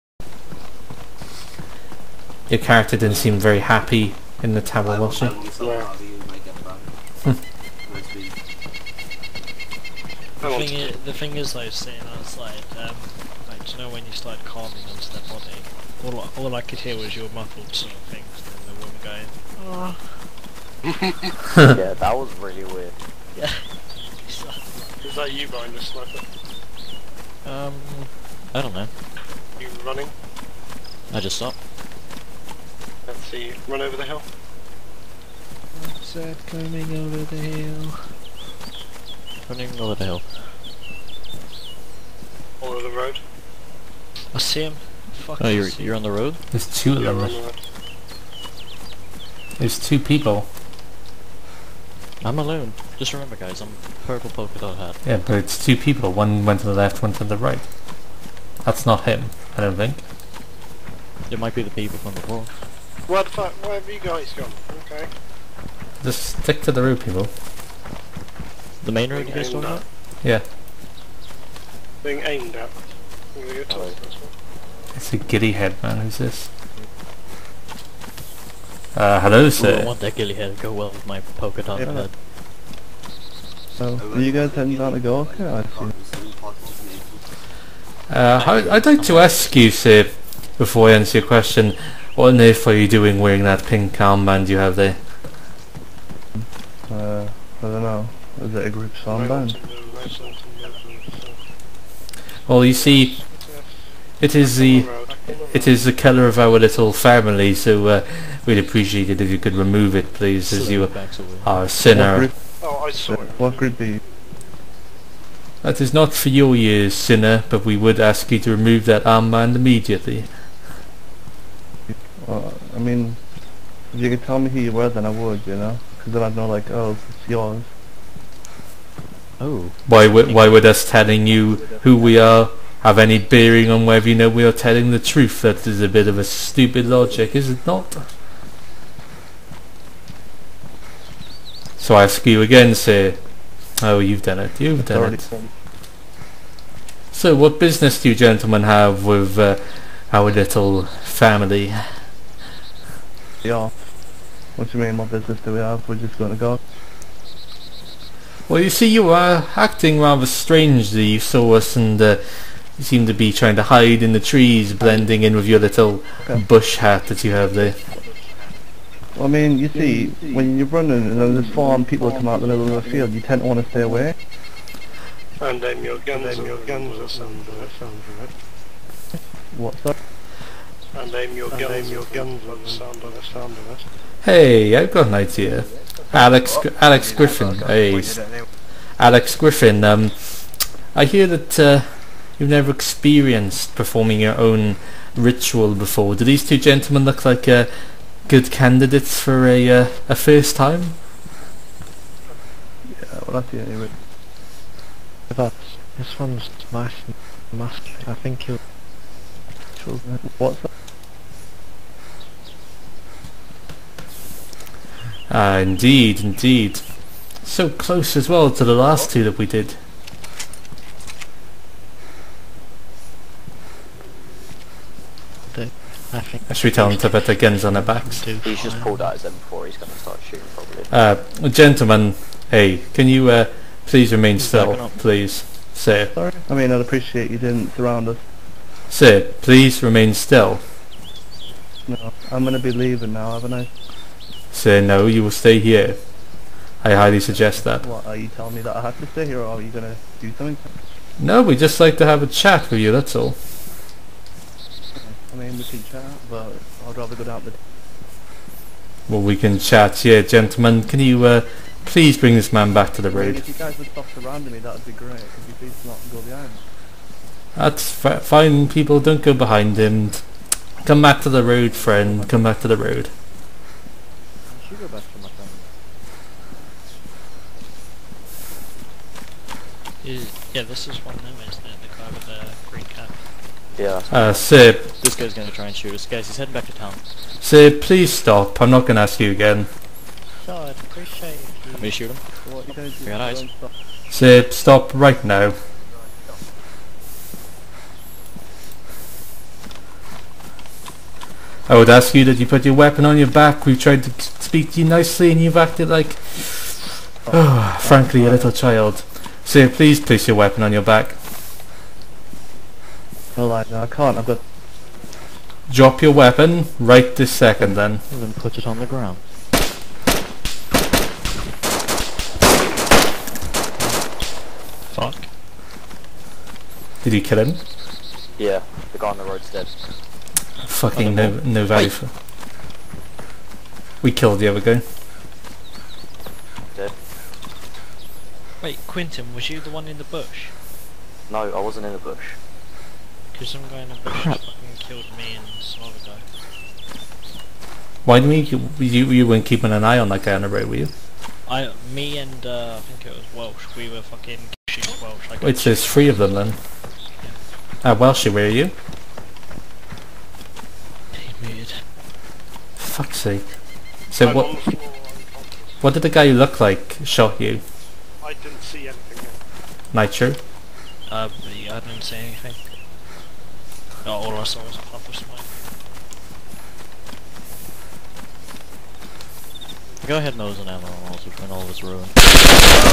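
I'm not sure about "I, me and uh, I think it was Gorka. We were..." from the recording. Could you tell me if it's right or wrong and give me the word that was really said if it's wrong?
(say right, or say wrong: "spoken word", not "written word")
wrong: "Welsh", not "Gorka".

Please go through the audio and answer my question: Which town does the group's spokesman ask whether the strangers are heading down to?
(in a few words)
Gorka.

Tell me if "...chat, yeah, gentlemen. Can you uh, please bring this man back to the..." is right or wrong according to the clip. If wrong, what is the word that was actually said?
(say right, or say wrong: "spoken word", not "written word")
right.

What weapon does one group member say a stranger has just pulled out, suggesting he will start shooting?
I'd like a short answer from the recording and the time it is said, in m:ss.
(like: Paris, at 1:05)
M4, at 3:49.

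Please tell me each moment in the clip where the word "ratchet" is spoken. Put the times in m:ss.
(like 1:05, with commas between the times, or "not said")
not said.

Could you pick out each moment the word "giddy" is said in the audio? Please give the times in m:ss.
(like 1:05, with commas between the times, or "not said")
1:15, 1:20.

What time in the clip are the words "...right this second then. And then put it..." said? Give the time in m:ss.
5:16.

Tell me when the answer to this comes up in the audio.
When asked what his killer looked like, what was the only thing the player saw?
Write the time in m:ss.
6:14.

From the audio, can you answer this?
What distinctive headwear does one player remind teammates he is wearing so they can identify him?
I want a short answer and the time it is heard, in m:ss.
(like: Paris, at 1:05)
purple polka dot hat, at 0:54.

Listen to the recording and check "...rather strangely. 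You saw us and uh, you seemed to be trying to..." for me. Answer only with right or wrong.
right.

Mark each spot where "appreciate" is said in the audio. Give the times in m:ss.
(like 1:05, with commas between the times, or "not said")
1:48, 3:56, 4:50.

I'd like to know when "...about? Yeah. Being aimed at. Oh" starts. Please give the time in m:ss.
1:09.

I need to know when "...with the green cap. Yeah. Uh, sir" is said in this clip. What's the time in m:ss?
4:42.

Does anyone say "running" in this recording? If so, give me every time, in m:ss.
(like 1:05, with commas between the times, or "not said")
0:29, 0:39, 2:50.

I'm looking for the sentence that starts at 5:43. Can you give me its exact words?
Because some guy in the bush fucking killed me and some other guy.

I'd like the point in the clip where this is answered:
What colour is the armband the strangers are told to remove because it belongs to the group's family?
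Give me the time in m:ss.
1:33.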